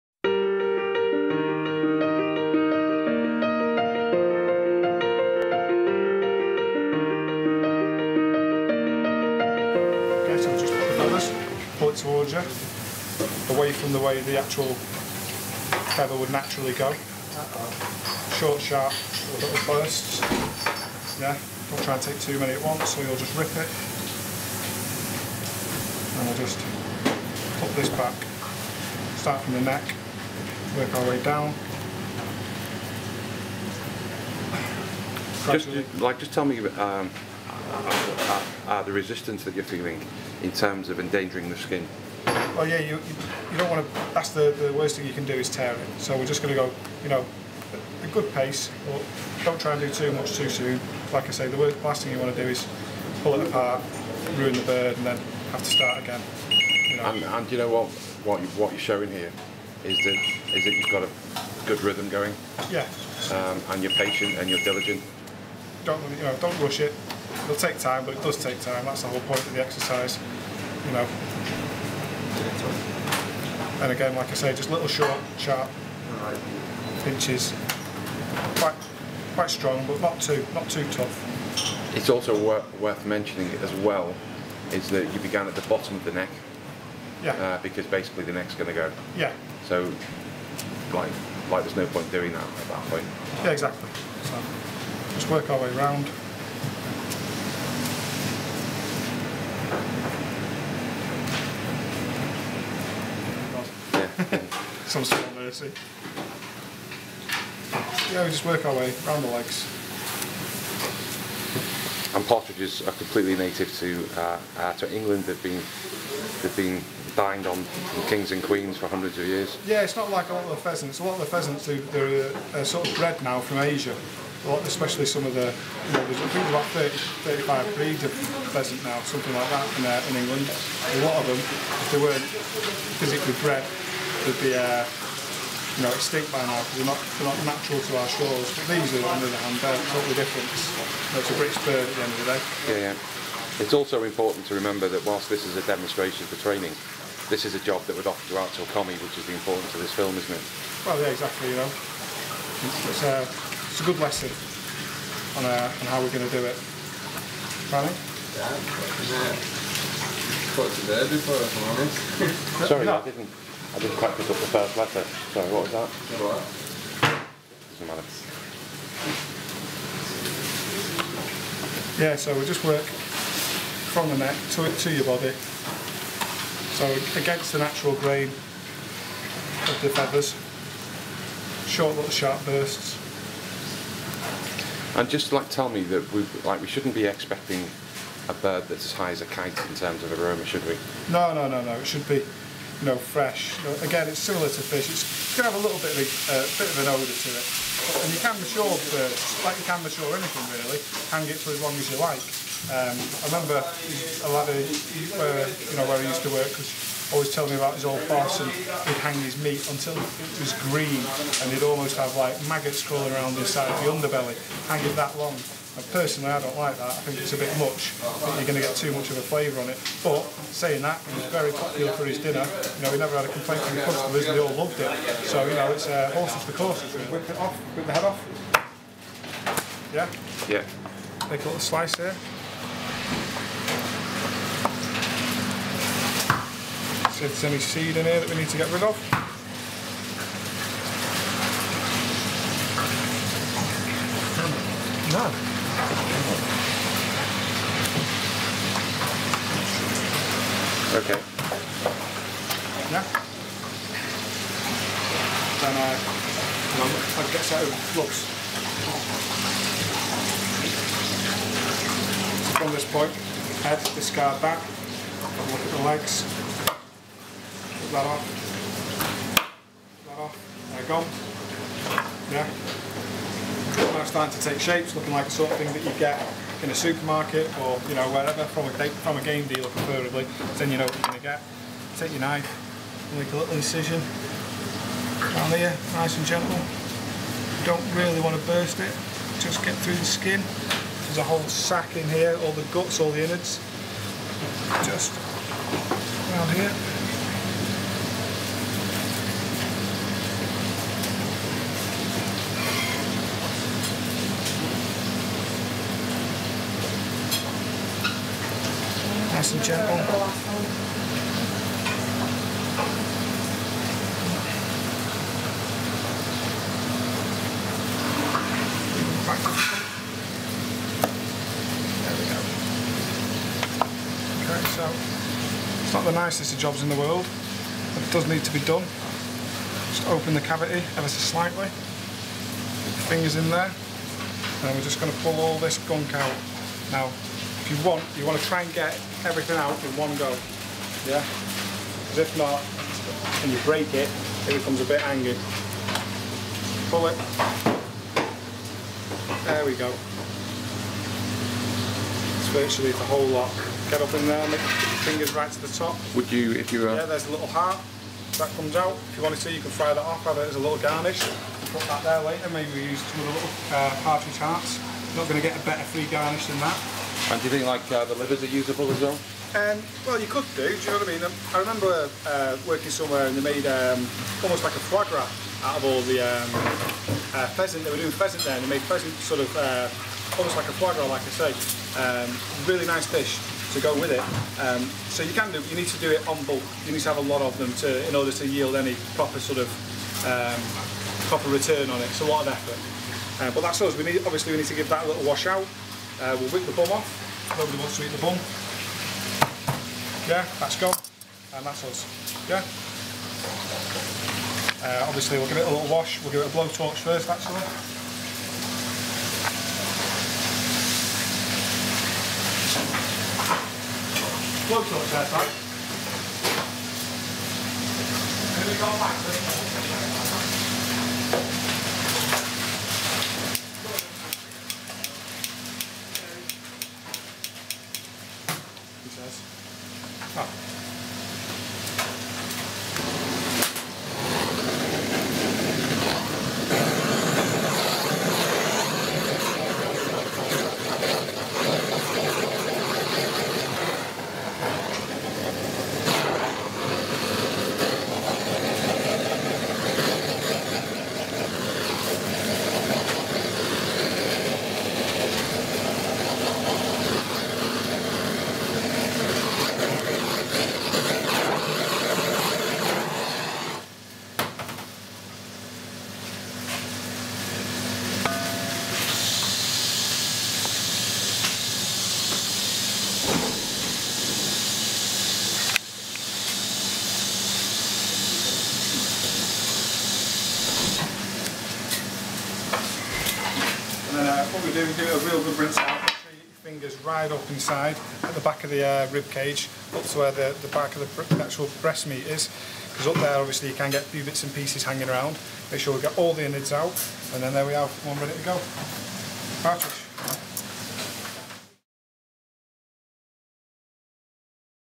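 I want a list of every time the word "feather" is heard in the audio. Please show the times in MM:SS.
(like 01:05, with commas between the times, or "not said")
00:15, 02:59.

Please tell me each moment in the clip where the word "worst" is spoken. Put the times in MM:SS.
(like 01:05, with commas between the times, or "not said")
00:44, 00:51.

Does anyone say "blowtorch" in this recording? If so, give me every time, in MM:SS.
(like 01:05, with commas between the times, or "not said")
06:46, 06:54.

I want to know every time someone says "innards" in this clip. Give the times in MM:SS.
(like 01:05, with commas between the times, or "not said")
04:53, 08:16.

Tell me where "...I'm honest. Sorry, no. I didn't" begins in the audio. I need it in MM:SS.
02:41.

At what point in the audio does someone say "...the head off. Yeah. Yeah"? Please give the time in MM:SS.
03:47.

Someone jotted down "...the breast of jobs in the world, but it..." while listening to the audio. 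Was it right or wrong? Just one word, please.
wrong.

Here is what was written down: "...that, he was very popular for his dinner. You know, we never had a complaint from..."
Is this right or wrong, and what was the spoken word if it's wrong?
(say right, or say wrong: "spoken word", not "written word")
right.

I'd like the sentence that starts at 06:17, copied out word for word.
They were doing pheasant there, and they made pheasant sort of uh, almost like a foie gras, like I say.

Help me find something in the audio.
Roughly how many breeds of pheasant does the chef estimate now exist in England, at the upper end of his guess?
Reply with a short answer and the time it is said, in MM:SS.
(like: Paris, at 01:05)
35, at 02:07.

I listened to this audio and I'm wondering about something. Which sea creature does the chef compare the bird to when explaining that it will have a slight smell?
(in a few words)
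Fish.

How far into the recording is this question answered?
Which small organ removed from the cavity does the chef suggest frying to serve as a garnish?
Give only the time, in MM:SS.
05:57.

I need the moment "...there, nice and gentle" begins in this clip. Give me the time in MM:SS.
04:45.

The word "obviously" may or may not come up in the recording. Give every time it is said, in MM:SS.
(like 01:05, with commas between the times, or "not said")
06:34, 06:45, 08:13.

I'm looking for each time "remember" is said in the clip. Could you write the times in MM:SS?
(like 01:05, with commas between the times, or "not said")
02:24, 03:23, 06:11.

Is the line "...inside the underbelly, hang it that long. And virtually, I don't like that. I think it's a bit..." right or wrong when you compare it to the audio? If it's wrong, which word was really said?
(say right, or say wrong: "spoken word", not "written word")
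wrong: "personally", not "virtually".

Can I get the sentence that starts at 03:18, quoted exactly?
And you can mature birds, like you can mature anything really, hang it for as long as you like.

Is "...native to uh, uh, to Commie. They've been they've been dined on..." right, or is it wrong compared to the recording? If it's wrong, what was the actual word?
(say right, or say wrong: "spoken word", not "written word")
wrong: "England", not "Commie".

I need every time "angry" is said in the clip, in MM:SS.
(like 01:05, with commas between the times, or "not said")
05:45.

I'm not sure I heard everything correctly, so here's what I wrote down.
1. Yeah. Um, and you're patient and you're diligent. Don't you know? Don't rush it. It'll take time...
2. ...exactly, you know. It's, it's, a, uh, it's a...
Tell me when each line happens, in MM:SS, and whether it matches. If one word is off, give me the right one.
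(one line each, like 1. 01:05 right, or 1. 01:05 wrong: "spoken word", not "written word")
1. 01:02 right
2. 02:31 right.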